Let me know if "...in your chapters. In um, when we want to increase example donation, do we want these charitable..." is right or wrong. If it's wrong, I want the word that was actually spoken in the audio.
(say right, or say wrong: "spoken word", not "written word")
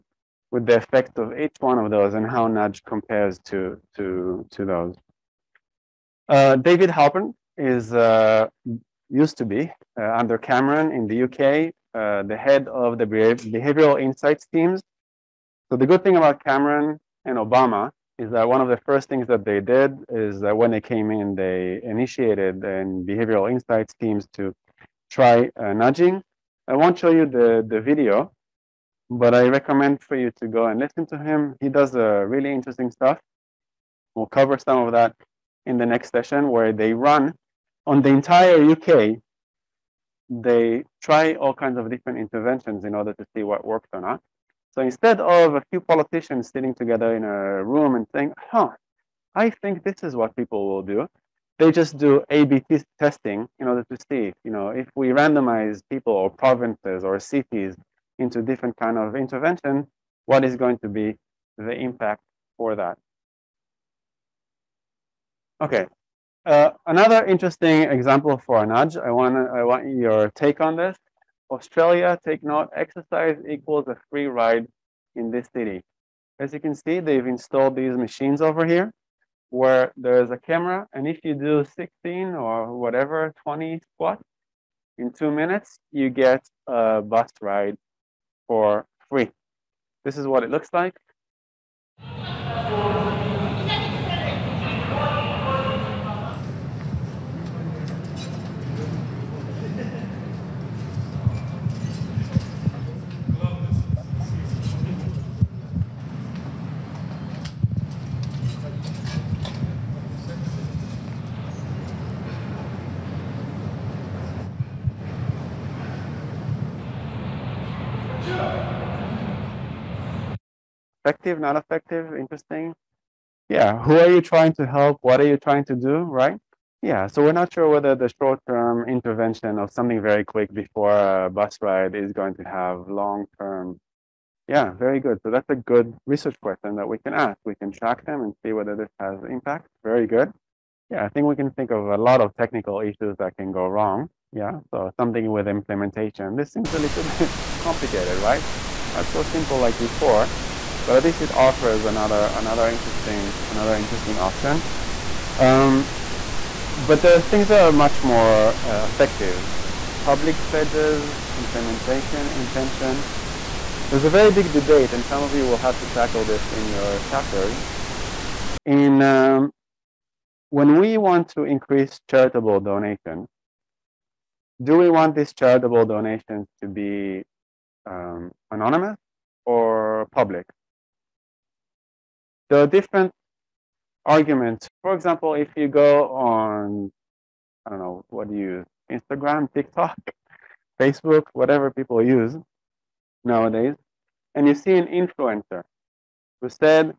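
wrong: "charitable", not "example".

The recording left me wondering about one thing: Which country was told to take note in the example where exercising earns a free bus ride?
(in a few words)
Australia.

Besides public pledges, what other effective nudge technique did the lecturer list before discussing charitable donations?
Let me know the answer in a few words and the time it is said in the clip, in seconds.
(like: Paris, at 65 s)
implementation intention, at 161 s.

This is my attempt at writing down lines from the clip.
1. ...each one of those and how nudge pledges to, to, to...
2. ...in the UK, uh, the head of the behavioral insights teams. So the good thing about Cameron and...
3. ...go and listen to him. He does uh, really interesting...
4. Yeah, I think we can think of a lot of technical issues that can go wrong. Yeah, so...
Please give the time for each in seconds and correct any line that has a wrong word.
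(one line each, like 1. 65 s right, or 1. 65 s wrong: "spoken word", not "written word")
1. 1 s wrong: "compares", not "pledges"
2. 10 s right
3. 30 s right
4. 140 s right.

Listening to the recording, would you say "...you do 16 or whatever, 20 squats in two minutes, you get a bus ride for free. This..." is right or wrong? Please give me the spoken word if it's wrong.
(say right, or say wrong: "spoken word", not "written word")
right.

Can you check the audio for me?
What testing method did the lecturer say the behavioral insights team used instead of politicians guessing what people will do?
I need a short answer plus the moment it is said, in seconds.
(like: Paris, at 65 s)
A-B testing, at 52 s.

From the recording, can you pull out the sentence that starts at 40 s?
They try all kinds of different interventions in order to see what works or not.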